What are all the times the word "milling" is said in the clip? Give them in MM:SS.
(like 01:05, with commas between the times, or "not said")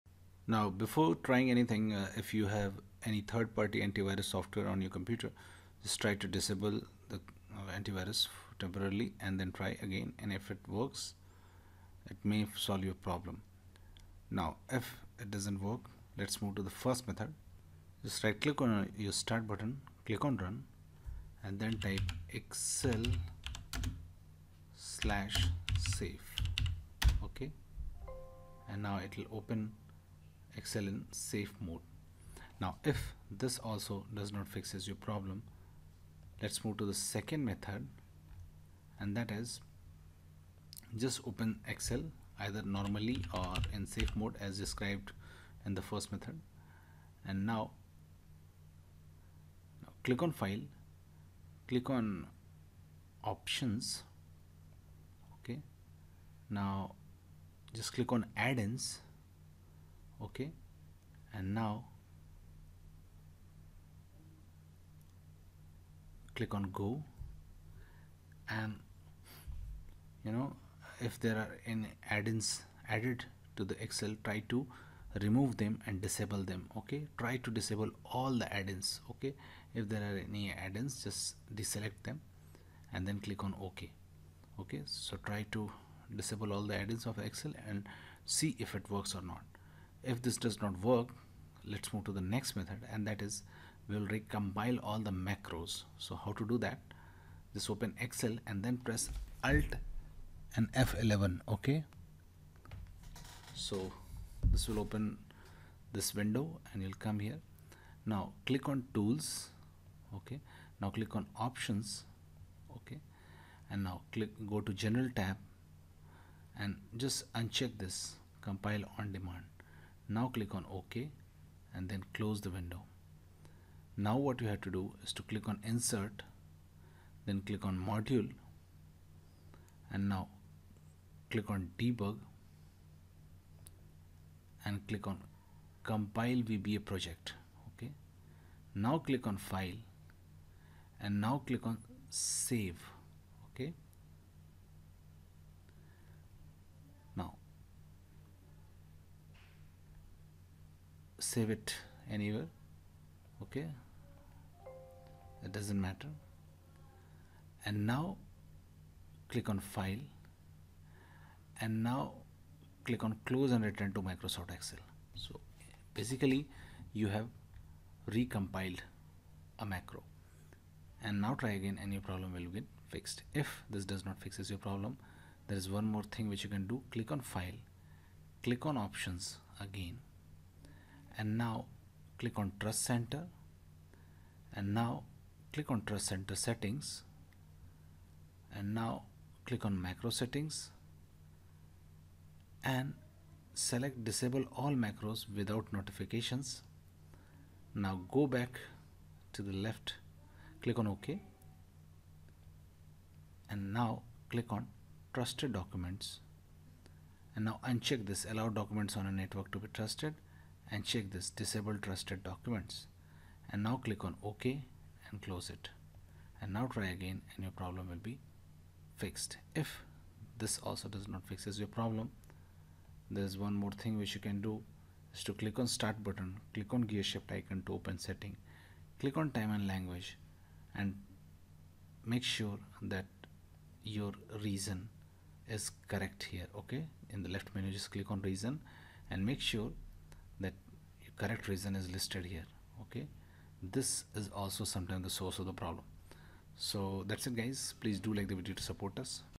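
not said.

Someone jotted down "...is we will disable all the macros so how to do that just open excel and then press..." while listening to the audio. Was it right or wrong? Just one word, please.
wrong.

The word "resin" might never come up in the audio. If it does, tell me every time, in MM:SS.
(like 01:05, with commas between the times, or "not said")
not said.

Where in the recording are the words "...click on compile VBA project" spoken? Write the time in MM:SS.
02:14.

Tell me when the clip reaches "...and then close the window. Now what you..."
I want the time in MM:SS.
02:01.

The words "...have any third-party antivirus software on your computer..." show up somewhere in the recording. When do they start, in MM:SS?
00:02.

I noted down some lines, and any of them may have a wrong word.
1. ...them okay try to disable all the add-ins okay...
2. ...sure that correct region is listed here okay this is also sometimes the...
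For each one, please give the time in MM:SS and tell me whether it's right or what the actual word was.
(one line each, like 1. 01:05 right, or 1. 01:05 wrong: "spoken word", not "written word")
1. 01:16 right
2. 03:59 right.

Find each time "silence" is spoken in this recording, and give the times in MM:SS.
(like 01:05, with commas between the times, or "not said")
not said.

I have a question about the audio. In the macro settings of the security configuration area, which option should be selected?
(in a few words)
disable all macros without notifications.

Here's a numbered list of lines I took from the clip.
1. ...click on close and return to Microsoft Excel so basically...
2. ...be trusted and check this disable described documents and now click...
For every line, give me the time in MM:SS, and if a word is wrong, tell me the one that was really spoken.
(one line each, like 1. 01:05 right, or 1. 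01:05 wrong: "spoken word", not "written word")
1. 02:42 right
2. 03:29 wrong: "trusted", not "described".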